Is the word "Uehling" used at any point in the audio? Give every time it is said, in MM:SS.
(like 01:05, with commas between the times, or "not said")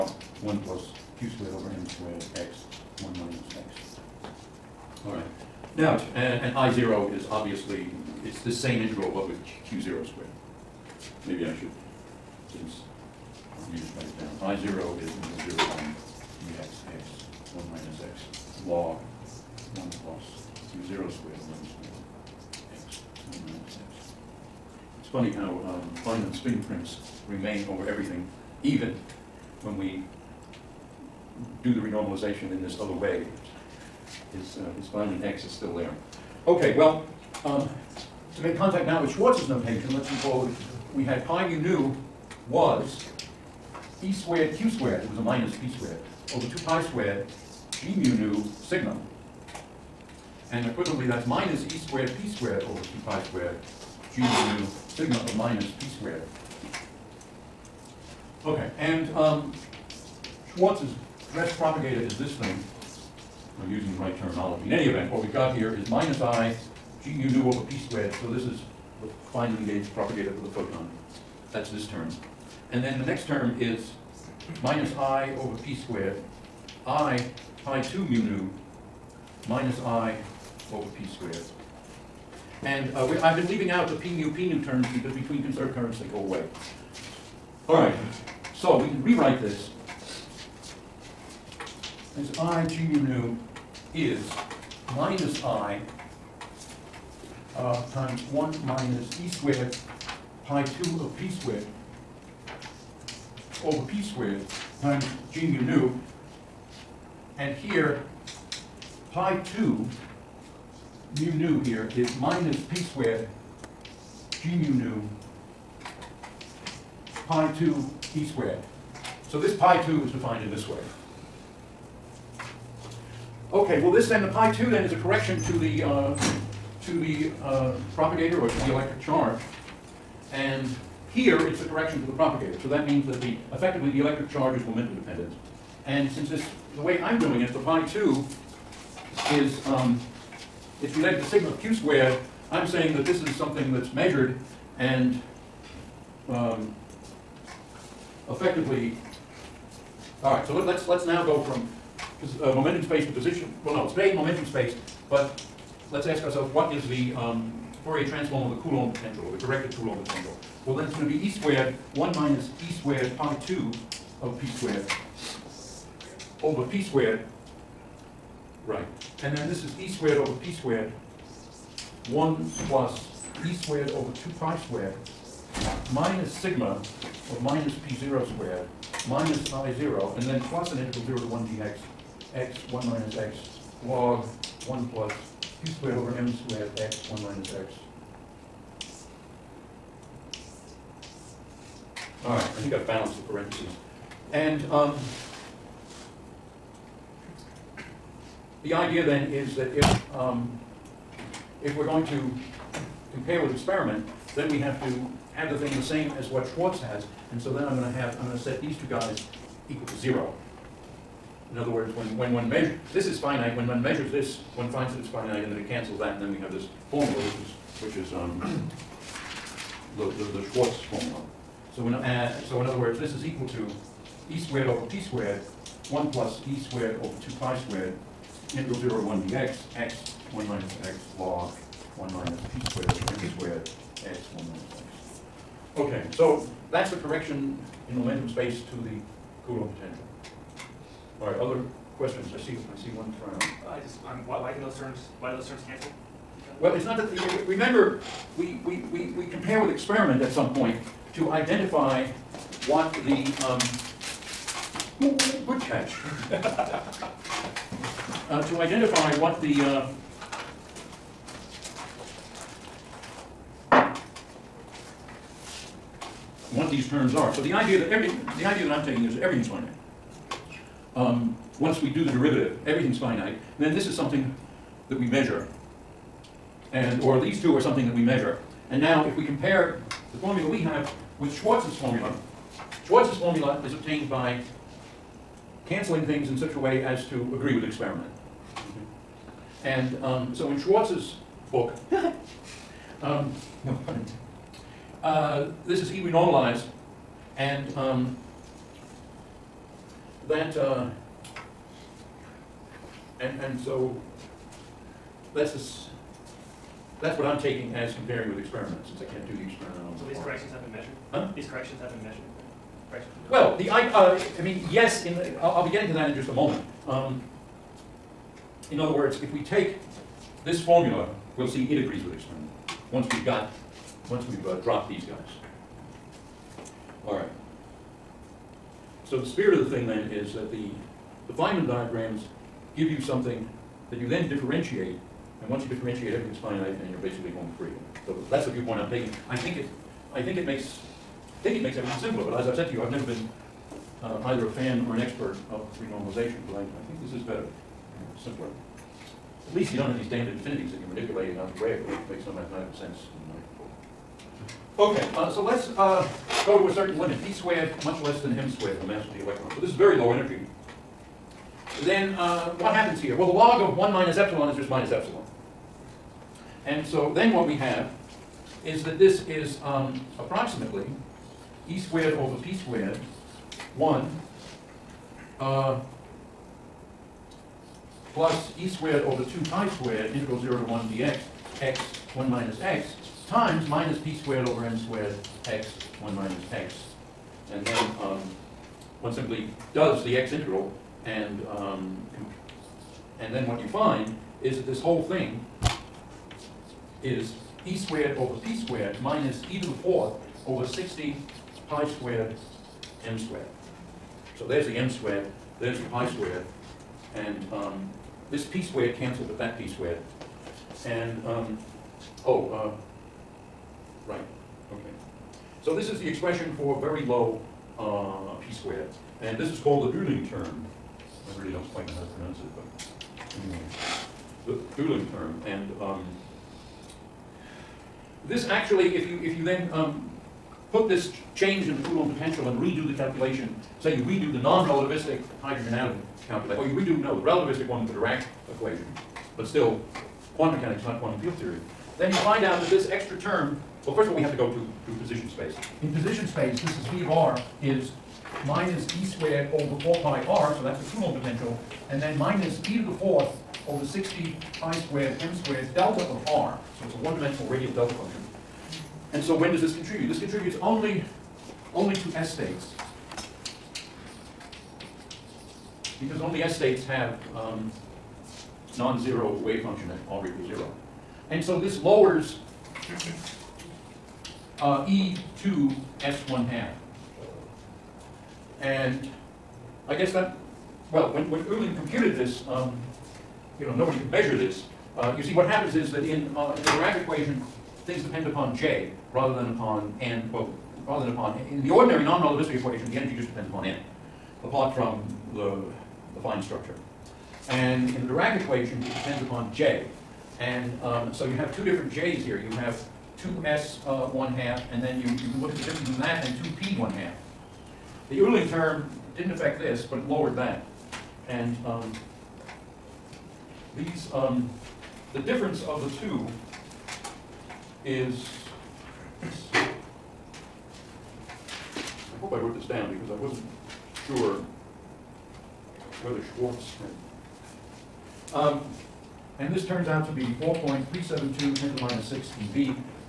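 06:59, 07:04, 08:01, 08:28.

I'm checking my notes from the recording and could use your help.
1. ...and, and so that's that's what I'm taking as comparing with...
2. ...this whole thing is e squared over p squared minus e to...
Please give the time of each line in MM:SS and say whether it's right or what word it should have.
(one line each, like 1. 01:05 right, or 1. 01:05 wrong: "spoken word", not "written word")
1. 05:03 right
2. 06:34 right.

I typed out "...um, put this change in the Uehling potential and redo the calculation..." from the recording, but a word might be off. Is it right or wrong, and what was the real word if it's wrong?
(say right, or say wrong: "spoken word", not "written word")
wrong: "Coulomb", not "Uehling".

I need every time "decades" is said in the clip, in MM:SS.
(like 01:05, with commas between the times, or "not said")
not said.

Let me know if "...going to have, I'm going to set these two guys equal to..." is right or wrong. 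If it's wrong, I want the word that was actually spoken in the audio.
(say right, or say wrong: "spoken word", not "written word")
right.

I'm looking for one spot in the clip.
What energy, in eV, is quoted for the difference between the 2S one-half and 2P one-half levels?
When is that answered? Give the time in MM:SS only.
08:50.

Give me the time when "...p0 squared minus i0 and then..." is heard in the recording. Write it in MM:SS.
02:57.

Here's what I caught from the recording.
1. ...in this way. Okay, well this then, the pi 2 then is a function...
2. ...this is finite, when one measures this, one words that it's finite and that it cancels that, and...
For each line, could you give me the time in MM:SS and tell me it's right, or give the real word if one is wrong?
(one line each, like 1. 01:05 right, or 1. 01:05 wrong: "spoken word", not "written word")
1. 02:00 wrong: "correction", not "function"
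2. 03:32 wrong: "finds", not "words".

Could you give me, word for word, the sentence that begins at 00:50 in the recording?
And equivalently, that's minus e squared p squared over 2 pi squared g mu sigma of minus p squared.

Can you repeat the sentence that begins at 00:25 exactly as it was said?
It's funny how um, Feynman's fingerprints remain over everything, even when we do the renormalization in this other way.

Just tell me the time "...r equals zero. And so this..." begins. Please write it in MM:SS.
07:50.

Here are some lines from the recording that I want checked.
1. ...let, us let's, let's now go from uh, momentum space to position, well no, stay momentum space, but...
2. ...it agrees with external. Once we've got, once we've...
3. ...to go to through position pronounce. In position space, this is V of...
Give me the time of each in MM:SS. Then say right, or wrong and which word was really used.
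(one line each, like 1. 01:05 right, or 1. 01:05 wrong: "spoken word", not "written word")
1. 02:30 right
2. 05:21 right
3. 07:24 wrong: "space", not "pronounce".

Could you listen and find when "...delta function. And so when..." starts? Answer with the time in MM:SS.
07:37.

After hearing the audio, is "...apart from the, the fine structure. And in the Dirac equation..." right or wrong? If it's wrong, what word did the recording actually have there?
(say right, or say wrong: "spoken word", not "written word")
right.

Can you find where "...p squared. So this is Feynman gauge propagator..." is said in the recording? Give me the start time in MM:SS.
01:07.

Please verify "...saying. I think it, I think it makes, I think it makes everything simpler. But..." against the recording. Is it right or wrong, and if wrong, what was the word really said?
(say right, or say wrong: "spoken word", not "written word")
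wrong: "taking", not "saying".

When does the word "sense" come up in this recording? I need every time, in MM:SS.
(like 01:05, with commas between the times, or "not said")
05:52.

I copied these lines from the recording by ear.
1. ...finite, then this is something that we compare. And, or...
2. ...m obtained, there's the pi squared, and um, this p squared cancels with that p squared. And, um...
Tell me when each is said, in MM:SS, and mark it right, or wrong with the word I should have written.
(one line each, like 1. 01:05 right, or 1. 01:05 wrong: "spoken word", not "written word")
1. 04:32 wrong: "measure", not "compare"
2. 06:44 wrong: "squared", not "obtained".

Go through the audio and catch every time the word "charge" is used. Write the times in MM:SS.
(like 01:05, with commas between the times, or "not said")
02:08, 02:14.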